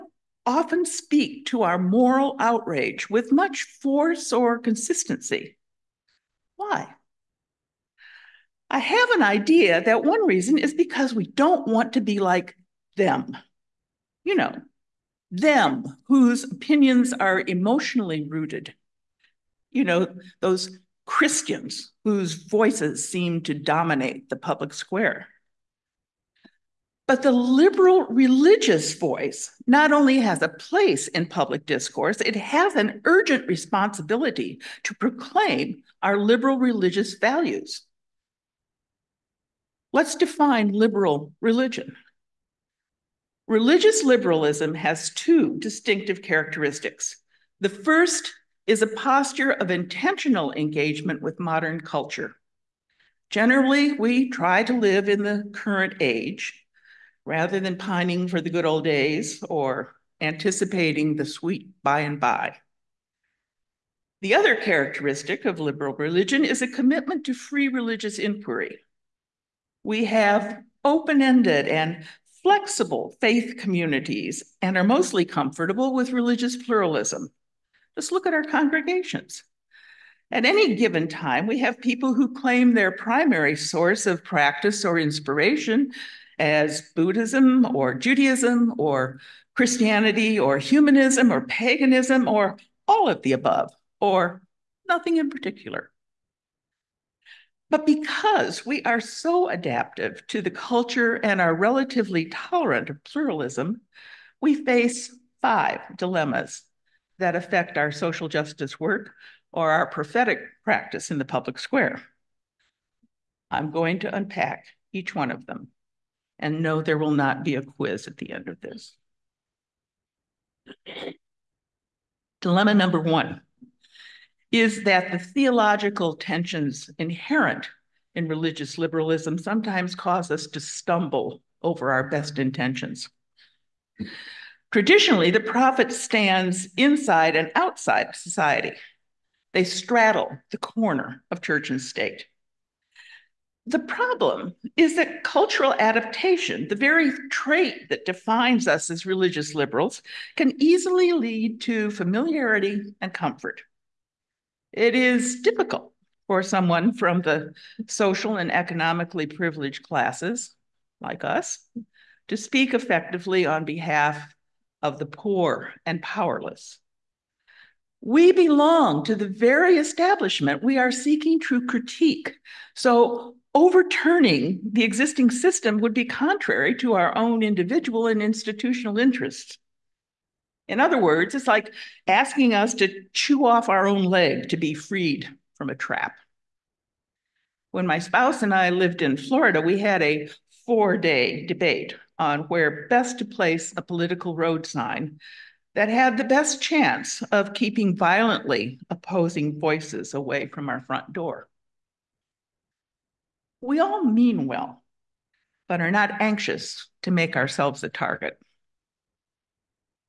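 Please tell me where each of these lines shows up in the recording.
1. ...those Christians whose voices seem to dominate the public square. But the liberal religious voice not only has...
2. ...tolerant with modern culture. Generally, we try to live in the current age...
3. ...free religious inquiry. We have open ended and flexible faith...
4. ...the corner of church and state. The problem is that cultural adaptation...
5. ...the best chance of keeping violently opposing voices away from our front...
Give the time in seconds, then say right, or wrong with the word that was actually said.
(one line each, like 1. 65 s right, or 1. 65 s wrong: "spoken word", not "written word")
1. 20 s right
2. 50 s wrong: "engagement", not "tolerant"
3. 67 s right
4. 140 s right
5. 196 s right.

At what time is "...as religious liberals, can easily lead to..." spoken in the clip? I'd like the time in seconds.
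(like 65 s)
148 s.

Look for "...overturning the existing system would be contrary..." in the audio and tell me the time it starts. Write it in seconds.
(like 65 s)
173 s.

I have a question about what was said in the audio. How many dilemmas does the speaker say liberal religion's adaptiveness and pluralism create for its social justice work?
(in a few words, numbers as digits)
5.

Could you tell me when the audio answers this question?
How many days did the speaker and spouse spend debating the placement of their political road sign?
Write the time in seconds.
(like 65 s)
190 s.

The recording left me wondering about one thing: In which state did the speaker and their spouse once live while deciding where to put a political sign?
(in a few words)
Florida.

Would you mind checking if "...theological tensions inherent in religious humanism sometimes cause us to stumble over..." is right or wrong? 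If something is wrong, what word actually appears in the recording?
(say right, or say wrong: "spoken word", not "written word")
wrong: "liberalism", not "humanism".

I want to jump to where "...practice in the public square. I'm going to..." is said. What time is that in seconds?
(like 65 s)
110 s.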